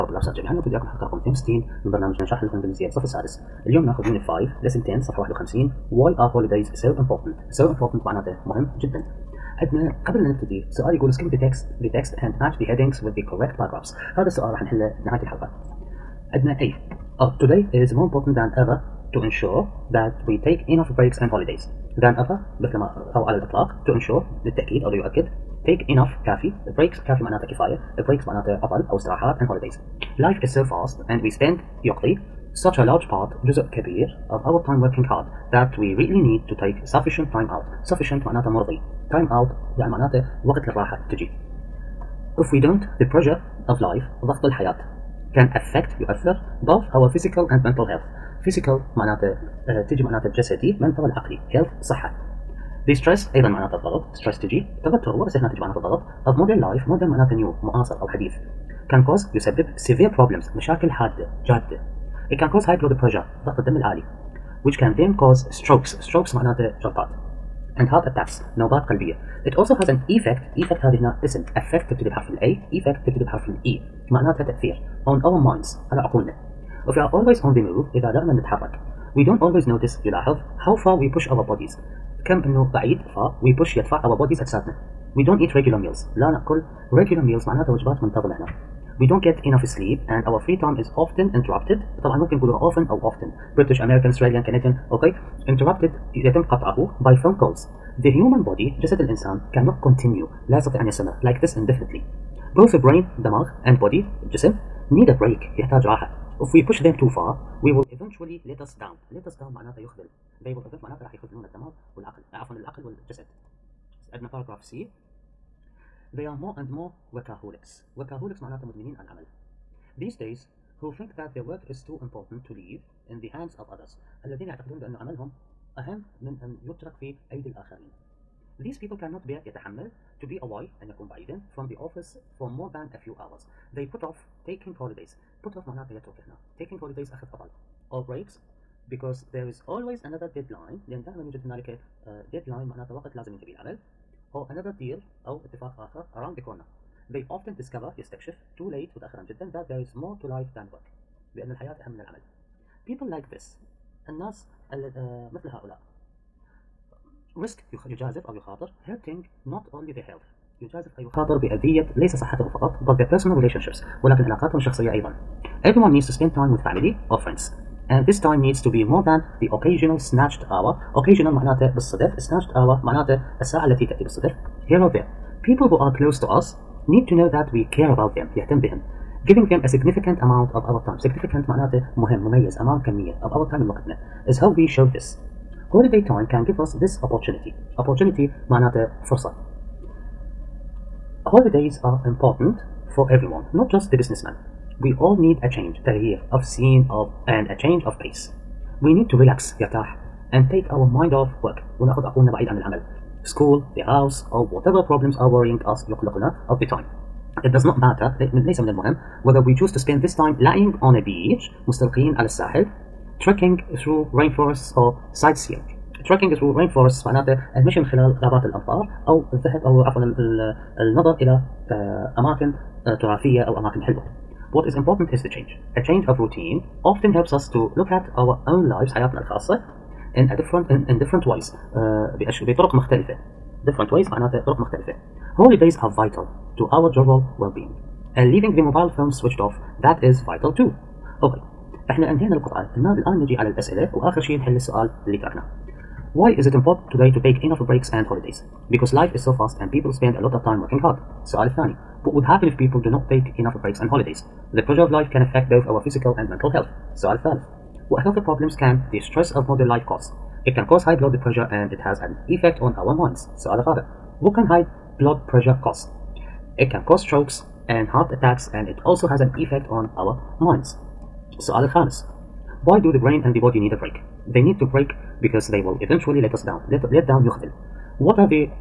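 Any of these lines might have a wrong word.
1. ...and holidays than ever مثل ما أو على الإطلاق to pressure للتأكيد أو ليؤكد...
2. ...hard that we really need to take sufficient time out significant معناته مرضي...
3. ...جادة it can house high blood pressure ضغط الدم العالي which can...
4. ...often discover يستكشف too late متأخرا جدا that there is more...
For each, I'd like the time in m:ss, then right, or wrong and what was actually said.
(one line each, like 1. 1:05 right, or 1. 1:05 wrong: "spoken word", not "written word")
1. 0:21 wrong: "ensure", not "pressure"
2. 0:35 wrong: "sufficient", not "significant"
3. 1:01 wrong: "cause", not "house"
4. 2:27 right.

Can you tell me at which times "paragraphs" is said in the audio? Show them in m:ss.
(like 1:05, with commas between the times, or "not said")
0:13, 1:54.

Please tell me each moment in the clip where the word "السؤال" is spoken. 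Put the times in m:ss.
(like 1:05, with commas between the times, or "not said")
0:14, 4:04, 4:11.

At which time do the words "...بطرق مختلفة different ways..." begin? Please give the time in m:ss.
3:52.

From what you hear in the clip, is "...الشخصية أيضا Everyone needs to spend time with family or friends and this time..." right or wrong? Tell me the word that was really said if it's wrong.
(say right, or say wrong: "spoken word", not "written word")
right.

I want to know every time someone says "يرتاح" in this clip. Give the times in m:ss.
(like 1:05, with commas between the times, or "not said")
3:19.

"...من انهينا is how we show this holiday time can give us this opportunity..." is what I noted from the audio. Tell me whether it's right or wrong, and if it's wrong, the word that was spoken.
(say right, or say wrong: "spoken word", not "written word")
wrong: "وقتنا", not "انهينا".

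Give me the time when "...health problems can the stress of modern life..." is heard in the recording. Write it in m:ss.
4:18.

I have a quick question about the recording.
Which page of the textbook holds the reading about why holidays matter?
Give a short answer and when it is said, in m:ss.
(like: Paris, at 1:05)
51, at 0:05.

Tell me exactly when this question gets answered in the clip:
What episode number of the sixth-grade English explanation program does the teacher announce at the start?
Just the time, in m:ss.
0:01.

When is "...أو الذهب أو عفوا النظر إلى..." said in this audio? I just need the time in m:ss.
3:39.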